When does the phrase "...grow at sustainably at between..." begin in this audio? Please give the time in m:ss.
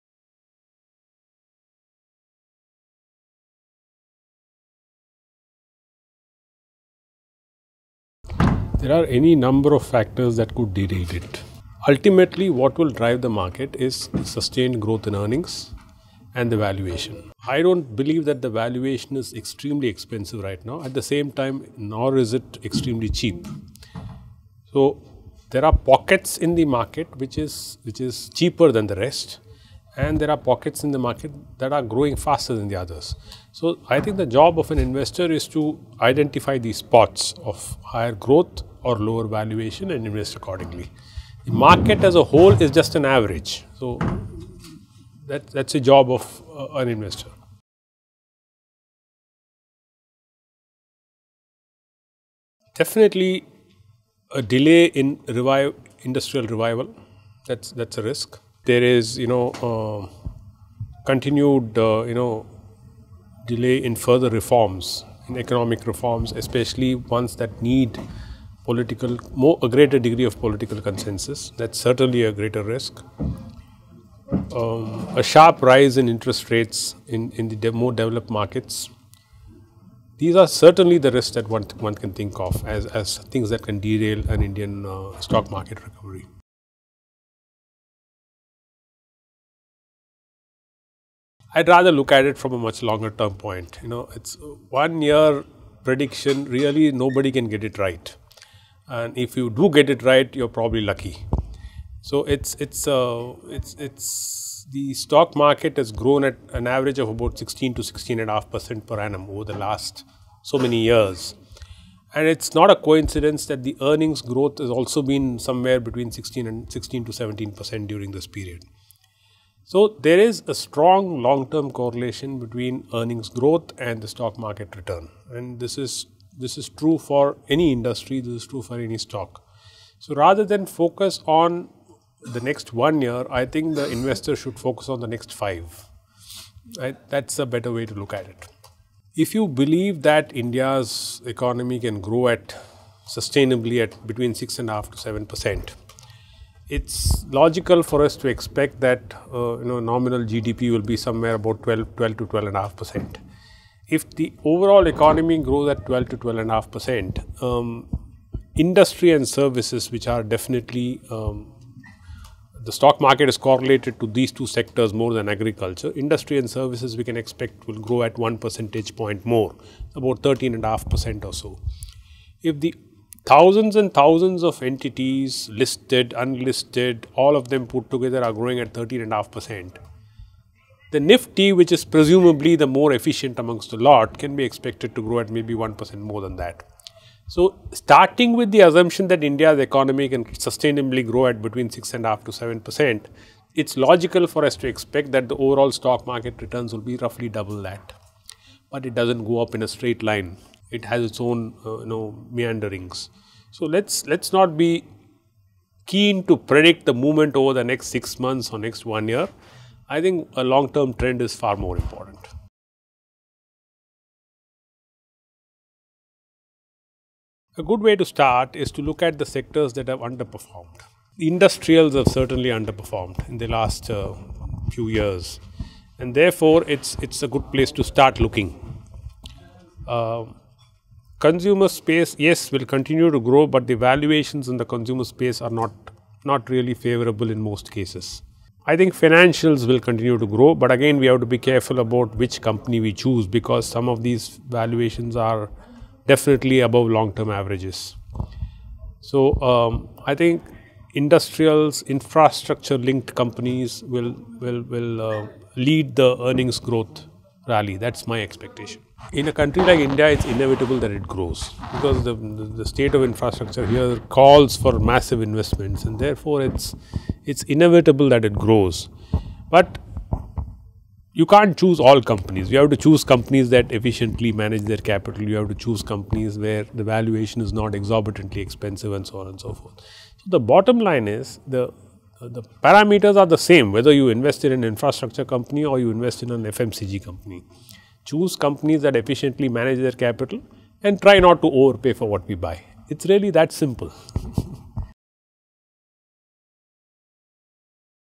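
2:21.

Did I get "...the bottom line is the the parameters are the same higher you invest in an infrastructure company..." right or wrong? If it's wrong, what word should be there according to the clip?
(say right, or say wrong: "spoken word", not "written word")
wrong: "whether", not "higher".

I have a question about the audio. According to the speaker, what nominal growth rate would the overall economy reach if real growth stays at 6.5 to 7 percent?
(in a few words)
12 to 12.5%.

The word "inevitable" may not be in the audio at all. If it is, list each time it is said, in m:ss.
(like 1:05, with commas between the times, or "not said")
4:20, 4:27.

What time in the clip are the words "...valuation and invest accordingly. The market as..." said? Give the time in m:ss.
0:39.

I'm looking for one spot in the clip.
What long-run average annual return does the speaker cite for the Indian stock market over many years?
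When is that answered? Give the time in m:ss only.
1:47.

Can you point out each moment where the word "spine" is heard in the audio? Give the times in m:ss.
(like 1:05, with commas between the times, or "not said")
not said.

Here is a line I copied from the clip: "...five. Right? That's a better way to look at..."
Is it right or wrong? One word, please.
right.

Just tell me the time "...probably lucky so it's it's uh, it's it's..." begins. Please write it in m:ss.
1:40.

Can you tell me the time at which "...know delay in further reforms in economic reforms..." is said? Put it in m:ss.
1:02.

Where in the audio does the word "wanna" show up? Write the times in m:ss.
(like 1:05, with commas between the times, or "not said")
not said.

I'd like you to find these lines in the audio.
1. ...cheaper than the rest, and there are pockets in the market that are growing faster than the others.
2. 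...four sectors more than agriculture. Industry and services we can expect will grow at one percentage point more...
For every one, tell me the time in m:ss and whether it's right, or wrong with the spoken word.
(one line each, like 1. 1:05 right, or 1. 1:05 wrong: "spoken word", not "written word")
1. 0:28 right
2. 2:44 wrong: "two", not "four".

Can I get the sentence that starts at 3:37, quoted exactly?
A good way to start is to look at the sectors that have underperformed.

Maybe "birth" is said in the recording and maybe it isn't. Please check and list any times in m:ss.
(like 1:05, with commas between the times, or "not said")
not said.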